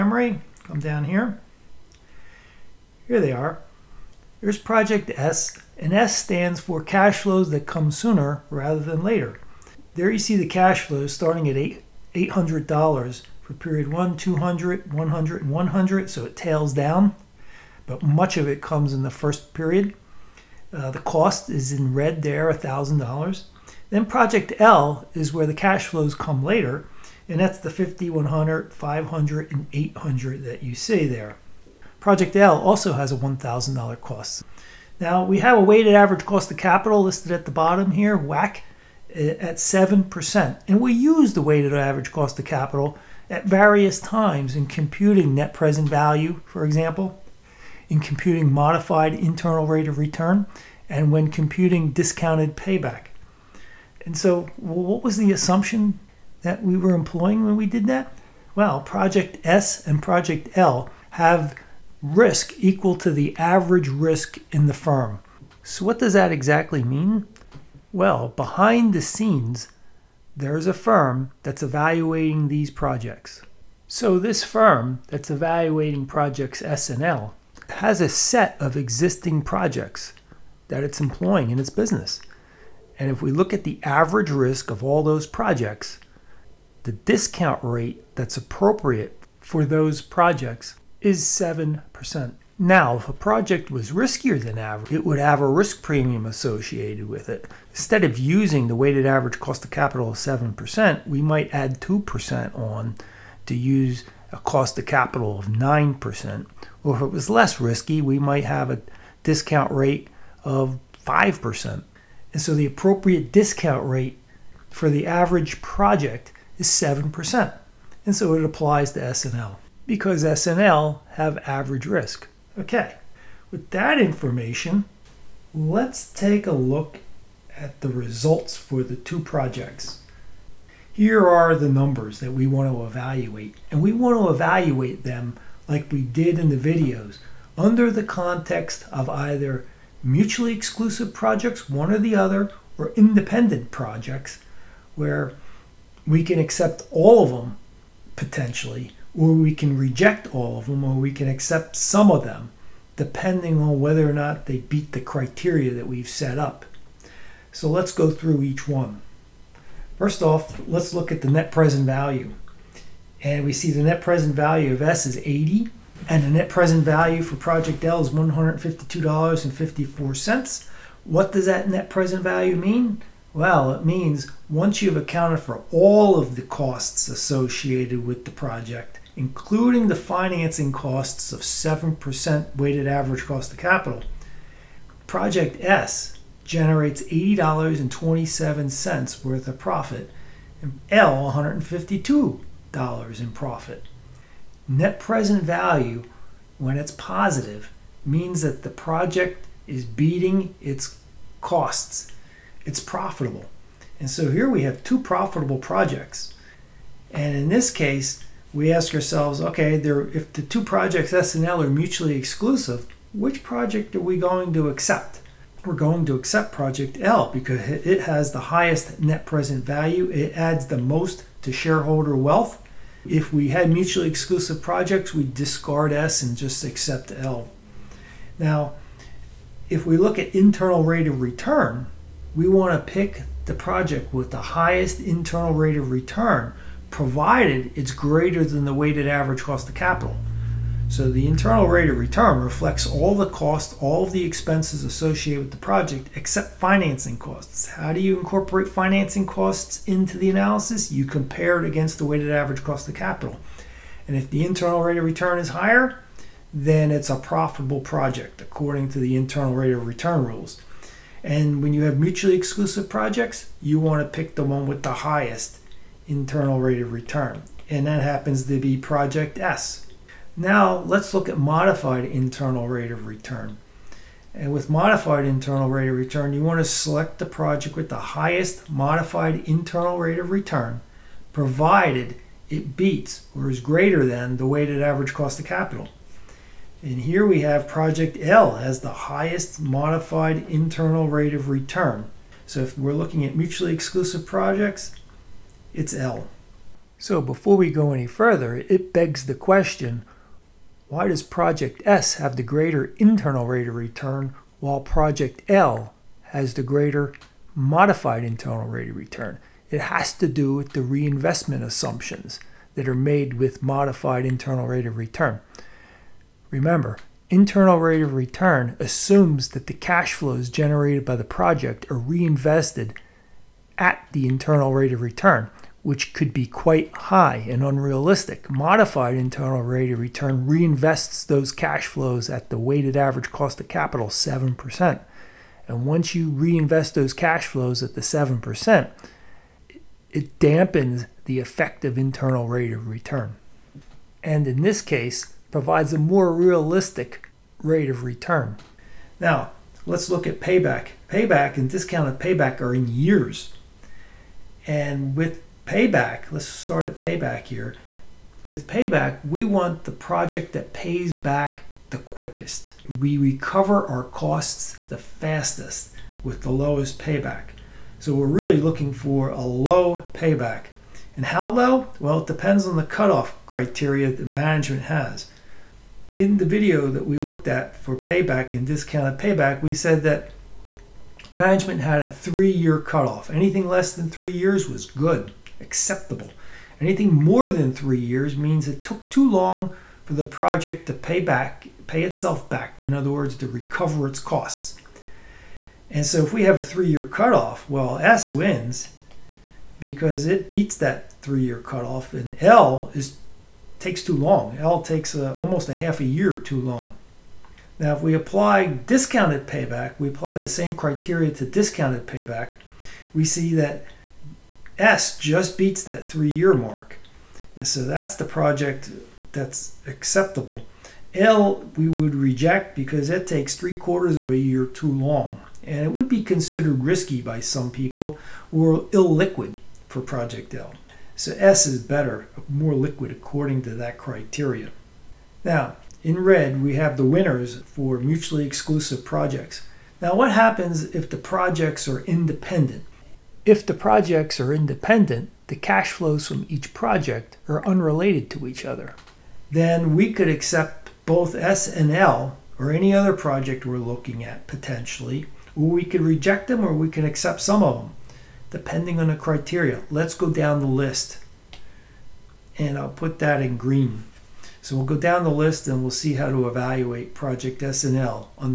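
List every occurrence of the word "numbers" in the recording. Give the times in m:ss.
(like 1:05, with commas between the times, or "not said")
2:11.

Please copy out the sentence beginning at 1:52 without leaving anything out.
And so the appropriate discount rate for the average project is 7%.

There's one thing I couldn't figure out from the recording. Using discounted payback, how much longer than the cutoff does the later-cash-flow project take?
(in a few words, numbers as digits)
three quarters of a year.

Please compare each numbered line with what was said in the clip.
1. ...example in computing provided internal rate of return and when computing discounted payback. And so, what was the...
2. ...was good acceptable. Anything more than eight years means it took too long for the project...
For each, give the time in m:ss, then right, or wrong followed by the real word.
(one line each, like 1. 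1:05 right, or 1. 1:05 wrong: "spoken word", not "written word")
1. 0:46 wrong: "modified", not "provided"
2. 6:24 wrong: "three", not "eight".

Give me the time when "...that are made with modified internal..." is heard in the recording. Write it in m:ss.
5:12.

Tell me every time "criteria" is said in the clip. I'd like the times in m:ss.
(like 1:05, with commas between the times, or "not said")
2:35, 6:13, 6:50, 7:13, 7:39.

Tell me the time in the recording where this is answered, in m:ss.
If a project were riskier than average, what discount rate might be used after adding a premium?
1:45.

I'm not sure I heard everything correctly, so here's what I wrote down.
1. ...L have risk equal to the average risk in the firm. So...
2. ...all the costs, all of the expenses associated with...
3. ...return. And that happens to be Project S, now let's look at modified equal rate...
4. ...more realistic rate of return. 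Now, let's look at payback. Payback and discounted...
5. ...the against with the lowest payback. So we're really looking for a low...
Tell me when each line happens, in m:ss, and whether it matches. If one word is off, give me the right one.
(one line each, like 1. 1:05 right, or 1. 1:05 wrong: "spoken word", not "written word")
1. 1:00 right
2. 4:02 right
3. 4:26 wrong: "internal", not "equal"
4. 5:45 right
5. 6:04 wrong: "fastest", not "against".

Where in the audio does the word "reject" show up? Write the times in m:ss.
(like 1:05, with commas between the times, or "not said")
2:29, 7:02, 7:36.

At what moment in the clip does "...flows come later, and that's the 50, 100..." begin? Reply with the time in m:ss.
0:25.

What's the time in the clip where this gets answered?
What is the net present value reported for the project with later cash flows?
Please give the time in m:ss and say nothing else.
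2:48.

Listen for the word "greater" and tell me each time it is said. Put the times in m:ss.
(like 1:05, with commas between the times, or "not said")
3:57, 4:43, 5:02, 5:06.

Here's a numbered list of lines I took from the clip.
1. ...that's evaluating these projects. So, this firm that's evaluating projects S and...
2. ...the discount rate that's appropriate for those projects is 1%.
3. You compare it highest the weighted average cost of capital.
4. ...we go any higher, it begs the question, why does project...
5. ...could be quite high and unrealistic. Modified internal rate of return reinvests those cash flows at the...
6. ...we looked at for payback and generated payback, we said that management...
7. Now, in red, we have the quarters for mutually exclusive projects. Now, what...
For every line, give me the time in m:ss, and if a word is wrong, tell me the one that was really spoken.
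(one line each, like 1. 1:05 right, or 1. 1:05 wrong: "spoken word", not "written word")
1. 1:11 right
2. 1:26 wrong: "7", not "1"
3. 4:10 wrong: "against", not "highest"
4. 4:57 wrong: "further", not "higher"
5. 5:26 right
6. 6:17 wrong: "discounted", not "generated"
7. 7:15 wrong: "winners", not "quarters".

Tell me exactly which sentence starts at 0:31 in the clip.
Project L also has a $1,000 cost.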